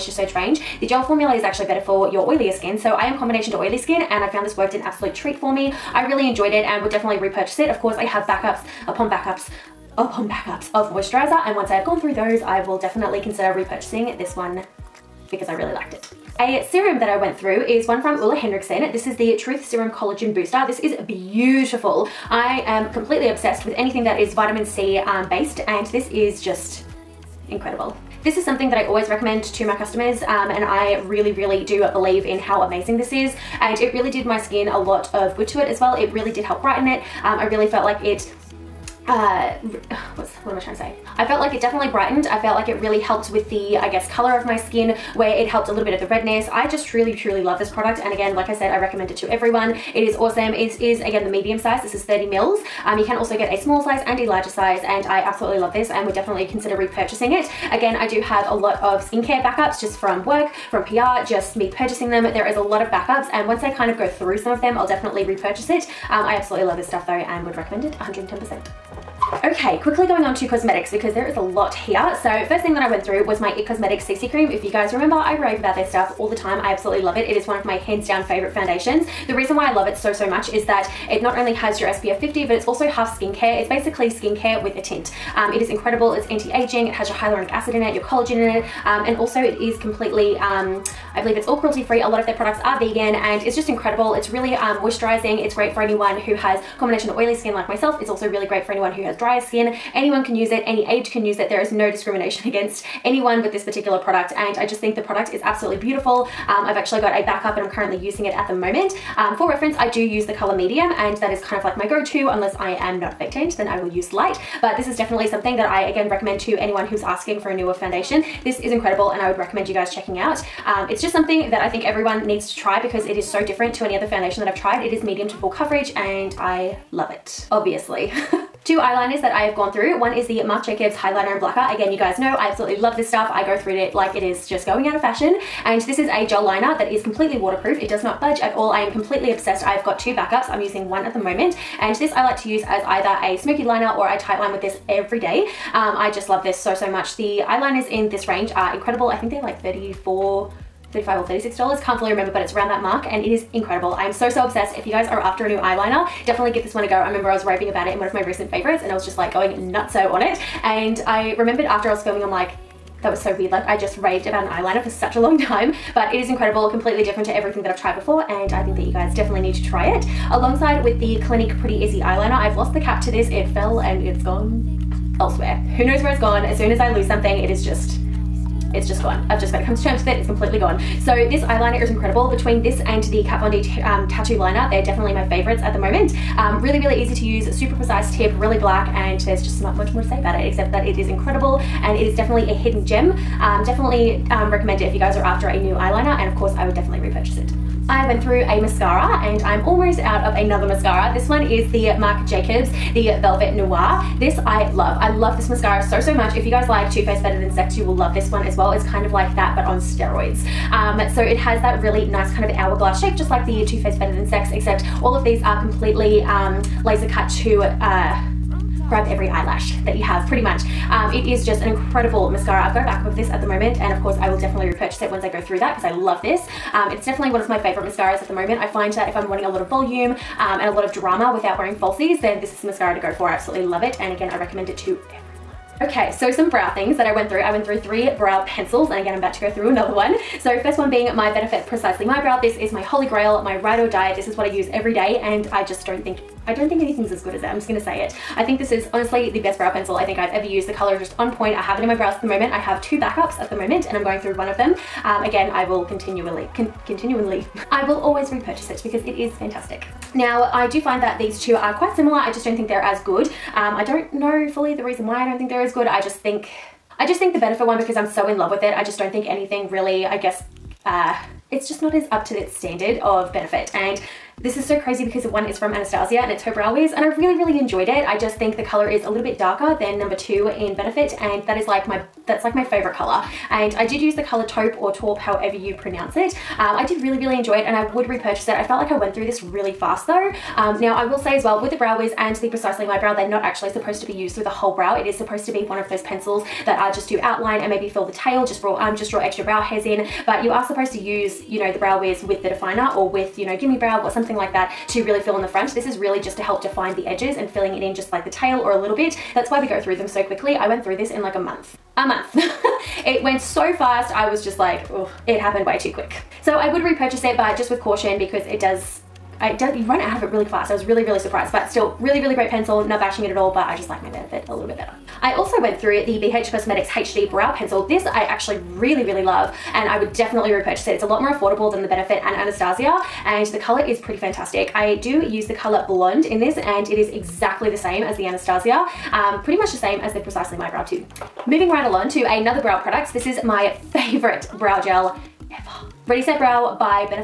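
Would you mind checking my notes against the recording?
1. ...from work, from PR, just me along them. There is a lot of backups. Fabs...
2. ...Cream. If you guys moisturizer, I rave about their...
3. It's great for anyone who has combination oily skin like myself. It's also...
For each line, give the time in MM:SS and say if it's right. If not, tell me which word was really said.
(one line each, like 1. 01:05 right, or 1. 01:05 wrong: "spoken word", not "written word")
1. 00:59 wrong: "purchasing", not "along"
2. 01:14 wrong: "remember", not "moisturizer"
3. 01:35 right.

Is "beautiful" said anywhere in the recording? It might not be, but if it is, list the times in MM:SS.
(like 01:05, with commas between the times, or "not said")
00:21, 01:45.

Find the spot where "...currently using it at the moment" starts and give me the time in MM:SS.
01:47.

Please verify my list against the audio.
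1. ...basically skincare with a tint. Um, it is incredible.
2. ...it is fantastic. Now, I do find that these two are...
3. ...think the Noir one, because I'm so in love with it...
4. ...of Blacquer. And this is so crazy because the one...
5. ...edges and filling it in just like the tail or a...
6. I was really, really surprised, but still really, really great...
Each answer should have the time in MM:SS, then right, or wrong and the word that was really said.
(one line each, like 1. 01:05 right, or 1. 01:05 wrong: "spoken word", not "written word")
1. 01:23 right
2. 04:19 right
3. 04:27 wrong: "Benefit", not "Noir"
4. 04:32 wrong: "Benefit", not "Blacquer"
5. 05:07 right
6. 05:20 right.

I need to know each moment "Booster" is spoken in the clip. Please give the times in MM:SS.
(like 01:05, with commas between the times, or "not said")
00:20.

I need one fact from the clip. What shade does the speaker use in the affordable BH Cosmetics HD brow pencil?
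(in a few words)
Blonde.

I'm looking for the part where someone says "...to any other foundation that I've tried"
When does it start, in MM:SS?
02:03.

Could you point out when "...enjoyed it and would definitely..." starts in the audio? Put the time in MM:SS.
00:06.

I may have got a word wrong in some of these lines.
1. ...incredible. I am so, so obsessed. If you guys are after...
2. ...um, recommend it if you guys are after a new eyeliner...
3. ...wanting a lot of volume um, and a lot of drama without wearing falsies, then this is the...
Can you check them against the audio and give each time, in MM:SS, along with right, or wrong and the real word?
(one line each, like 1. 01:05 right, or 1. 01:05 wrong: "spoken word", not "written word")
1. 02:33 right
2. 03:14 right
3. 03:49 right.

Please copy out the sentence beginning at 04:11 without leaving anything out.
I have it in my brows at the moment.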